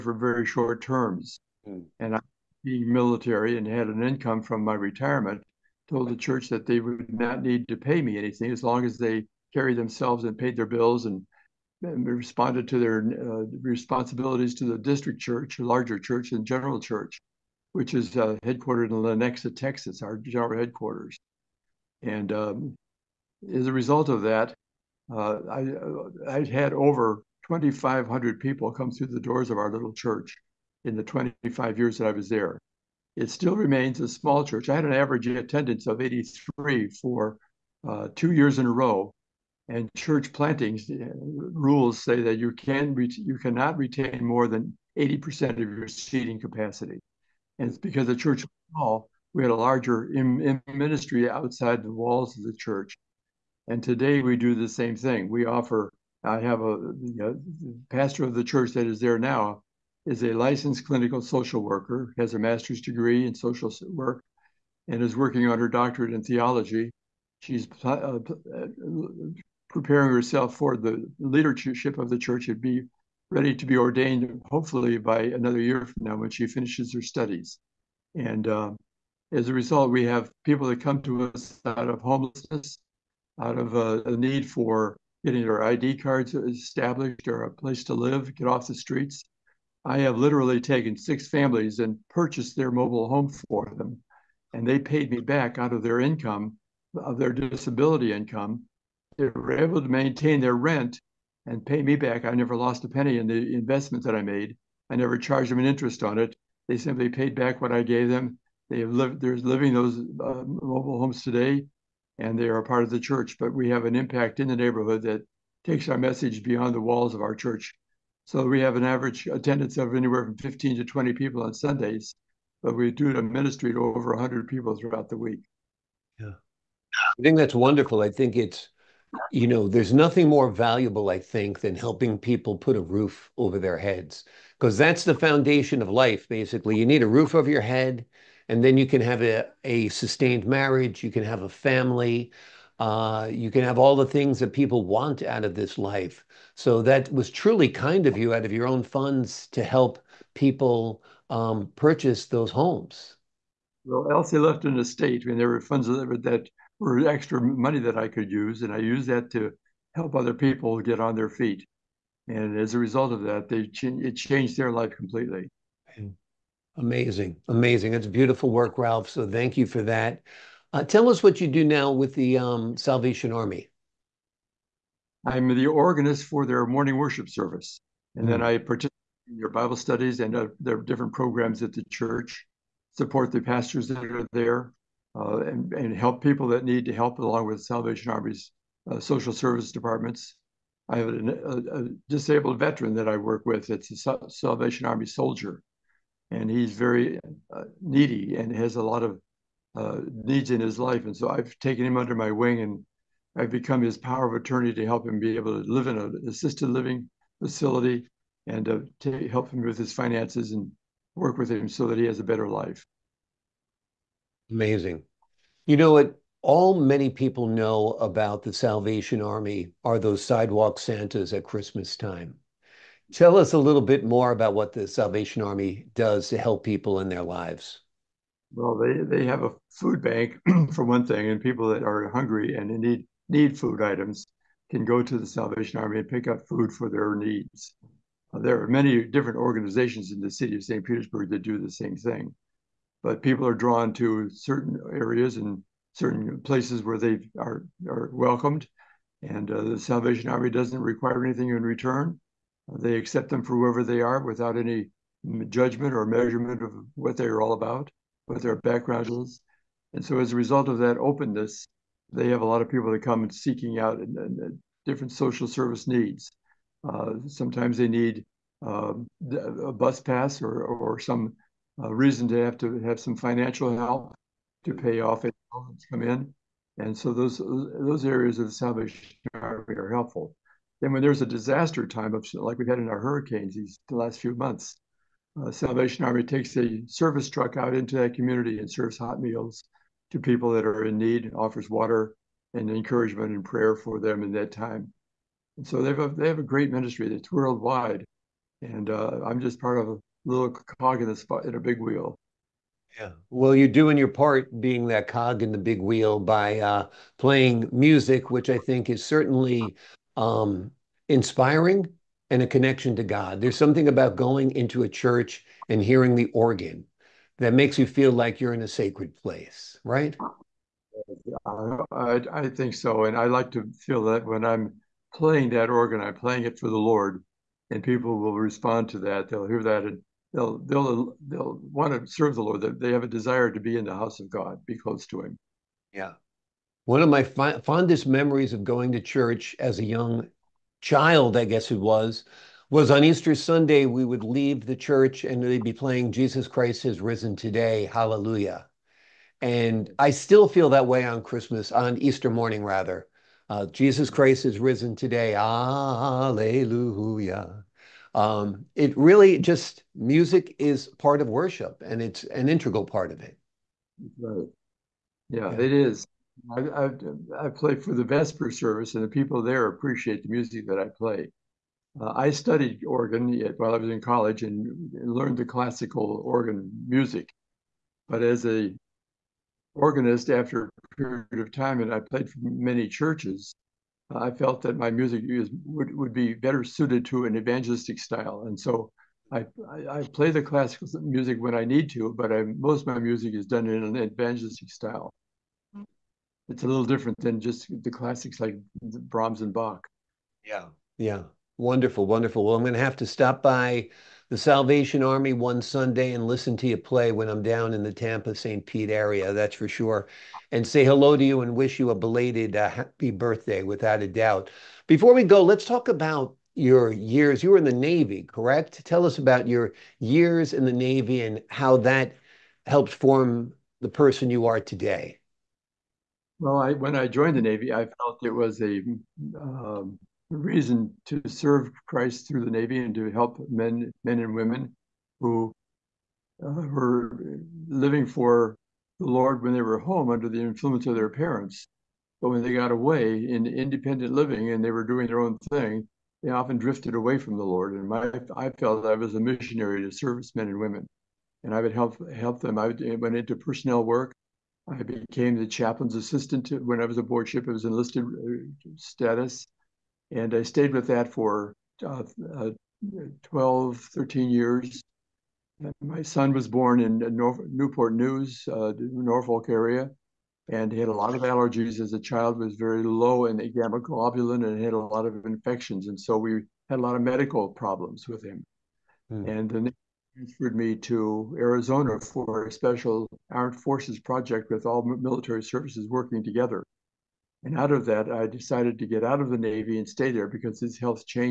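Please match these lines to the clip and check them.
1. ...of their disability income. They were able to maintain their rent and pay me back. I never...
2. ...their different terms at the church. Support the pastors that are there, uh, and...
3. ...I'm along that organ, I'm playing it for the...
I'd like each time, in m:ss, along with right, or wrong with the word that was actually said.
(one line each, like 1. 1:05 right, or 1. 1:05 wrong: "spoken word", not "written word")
1. 1:36 right
2. 3:00 wrong: "programs", not "terms"
3. 5:24 wrong: "playing", not "along".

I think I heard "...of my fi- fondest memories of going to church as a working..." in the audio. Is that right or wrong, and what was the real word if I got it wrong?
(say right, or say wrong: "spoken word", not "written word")
wrong: "young", not "working".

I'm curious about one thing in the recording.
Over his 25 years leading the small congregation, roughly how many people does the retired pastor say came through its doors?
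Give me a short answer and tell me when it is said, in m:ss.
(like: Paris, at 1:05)
2,500, at 0:27.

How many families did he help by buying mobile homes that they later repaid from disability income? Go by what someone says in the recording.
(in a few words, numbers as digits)
6.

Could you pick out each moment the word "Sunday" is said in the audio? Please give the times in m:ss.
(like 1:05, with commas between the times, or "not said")
2:01, 5:43, 6:45.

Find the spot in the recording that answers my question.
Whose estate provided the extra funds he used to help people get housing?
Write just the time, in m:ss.
2:34.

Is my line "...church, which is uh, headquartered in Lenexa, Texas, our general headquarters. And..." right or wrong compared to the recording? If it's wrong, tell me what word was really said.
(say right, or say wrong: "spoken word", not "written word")
right.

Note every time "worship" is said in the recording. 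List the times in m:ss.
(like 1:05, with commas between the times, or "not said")
2:56, 6:01.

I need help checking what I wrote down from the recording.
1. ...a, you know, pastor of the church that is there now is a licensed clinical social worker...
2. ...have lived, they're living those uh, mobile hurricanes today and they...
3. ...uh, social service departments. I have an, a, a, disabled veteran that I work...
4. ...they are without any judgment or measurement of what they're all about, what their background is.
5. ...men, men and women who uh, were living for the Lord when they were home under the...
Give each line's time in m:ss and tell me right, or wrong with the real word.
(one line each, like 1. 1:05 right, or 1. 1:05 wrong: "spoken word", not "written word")
1. 0:56 right
2. 1:48 wrong: "homes", not "hurricanes"
3. 3:08 right
4. 4:13 right
5. 7:13 right.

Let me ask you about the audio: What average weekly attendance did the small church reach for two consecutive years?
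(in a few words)
83.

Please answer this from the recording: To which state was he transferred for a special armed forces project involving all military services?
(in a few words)
Arizona.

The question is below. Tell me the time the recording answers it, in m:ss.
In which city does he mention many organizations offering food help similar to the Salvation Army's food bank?
4:00.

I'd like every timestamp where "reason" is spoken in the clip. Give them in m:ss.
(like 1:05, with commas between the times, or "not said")
4:31, 7:10.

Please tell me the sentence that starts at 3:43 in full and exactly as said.
Tell us a little bit more about what the Salvation Army does to help people in their lives.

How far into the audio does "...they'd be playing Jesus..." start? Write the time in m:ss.
5:45.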